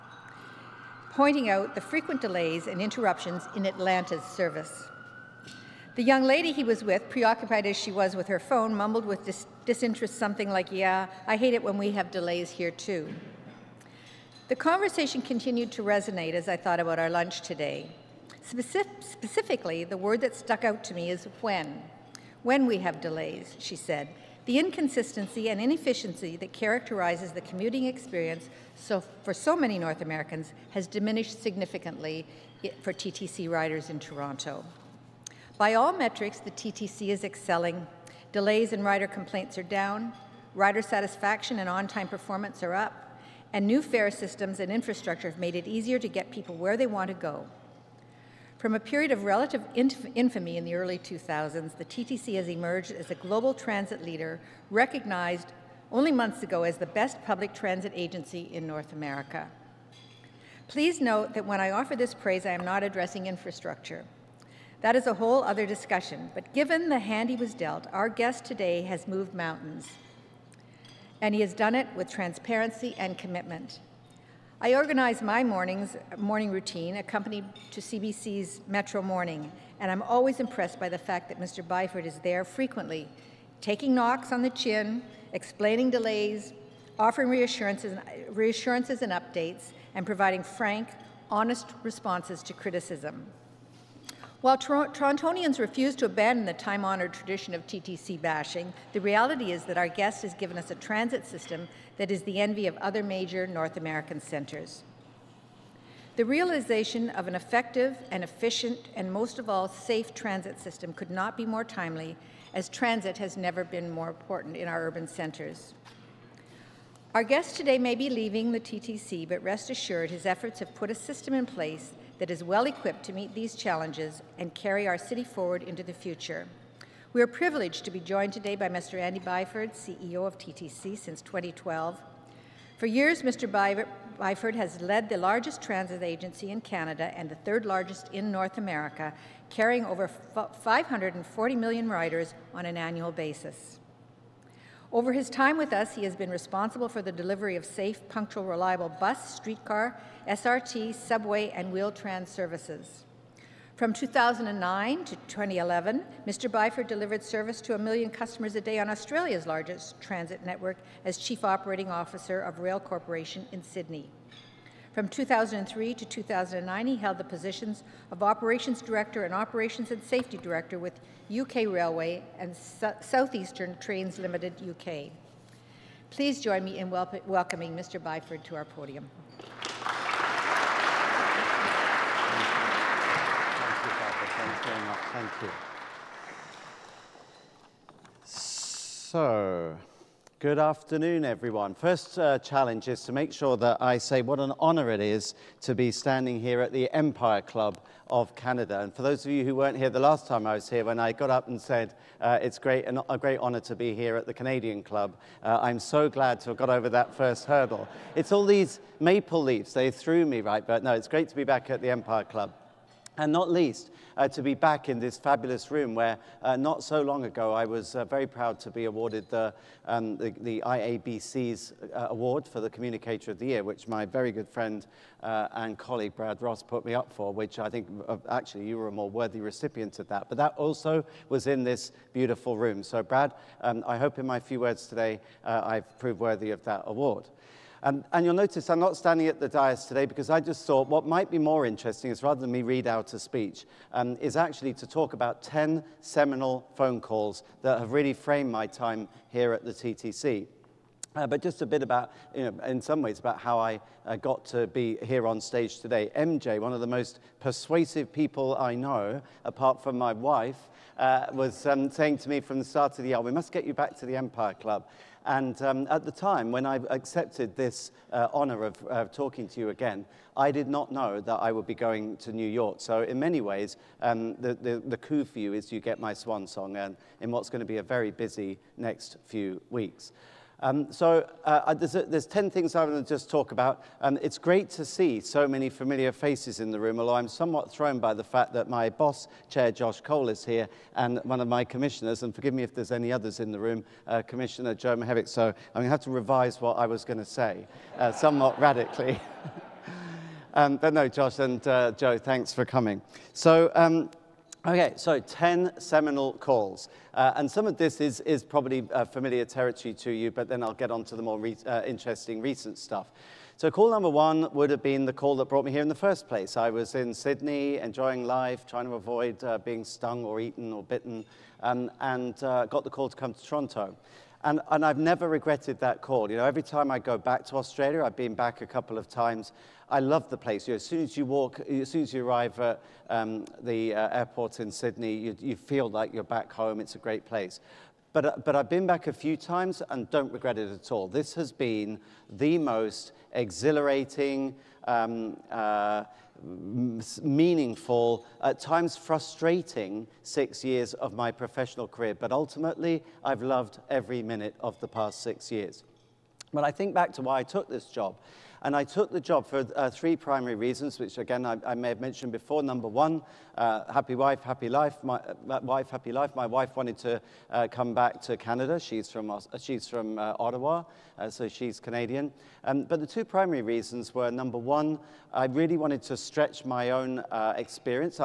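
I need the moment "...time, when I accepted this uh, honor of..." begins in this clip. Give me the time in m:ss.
4:26.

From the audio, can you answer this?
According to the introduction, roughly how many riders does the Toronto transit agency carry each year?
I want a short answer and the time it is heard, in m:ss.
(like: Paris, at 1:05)
540 million, at 2:20.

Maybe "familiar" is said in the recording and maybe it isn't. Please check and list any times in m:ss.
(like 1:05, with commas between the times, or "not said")
4:45, 5:09.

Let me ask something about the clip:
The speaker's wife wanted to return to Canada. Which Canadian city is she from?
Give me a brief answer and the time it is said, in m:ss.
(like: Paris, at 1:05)
Ottawa, at 6:10.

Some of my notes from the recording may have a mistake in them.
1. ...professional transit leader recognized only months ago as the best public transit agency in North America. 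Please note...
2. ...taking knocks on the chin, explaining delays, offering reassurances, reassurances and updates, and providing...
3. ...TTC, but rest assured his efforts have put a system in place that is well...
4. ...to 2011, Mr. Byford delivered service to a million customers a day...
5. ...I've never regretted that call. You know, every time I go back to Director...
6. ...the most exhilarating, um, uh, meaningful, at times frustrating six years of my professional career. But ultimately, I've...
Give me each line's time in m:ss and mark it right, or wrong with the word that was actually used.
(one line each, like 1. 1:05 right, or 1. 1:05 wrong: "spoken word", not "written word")
1. 0:53 wrong: "global", not "professional"
2. 1:23 right
3. 1:58 right
4. 2:35 right
5. 5:24 wrong: "Australia", not "Director"
6. 5:42 right.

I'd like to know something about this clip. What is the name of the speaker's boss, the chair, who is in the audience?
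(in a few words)
Josh Colle.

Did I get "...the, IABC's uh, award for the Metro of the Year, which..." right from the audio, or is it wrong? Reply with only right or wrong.
wrong.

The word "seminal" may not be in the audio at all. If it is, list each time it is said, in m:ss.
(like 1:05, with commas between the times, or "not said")
4:06, 5:05.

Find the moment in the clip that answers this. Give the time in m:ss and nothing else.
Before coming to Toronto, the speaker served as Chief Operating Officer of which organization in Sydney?
2:42.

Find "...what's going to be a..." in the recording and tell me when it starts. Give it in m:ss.
4:37.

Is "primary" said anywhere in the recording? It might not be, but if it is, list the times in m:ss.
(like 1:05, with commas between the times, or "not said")
6:00, 6:13.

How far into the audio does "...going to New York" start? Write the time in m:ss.
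4:31.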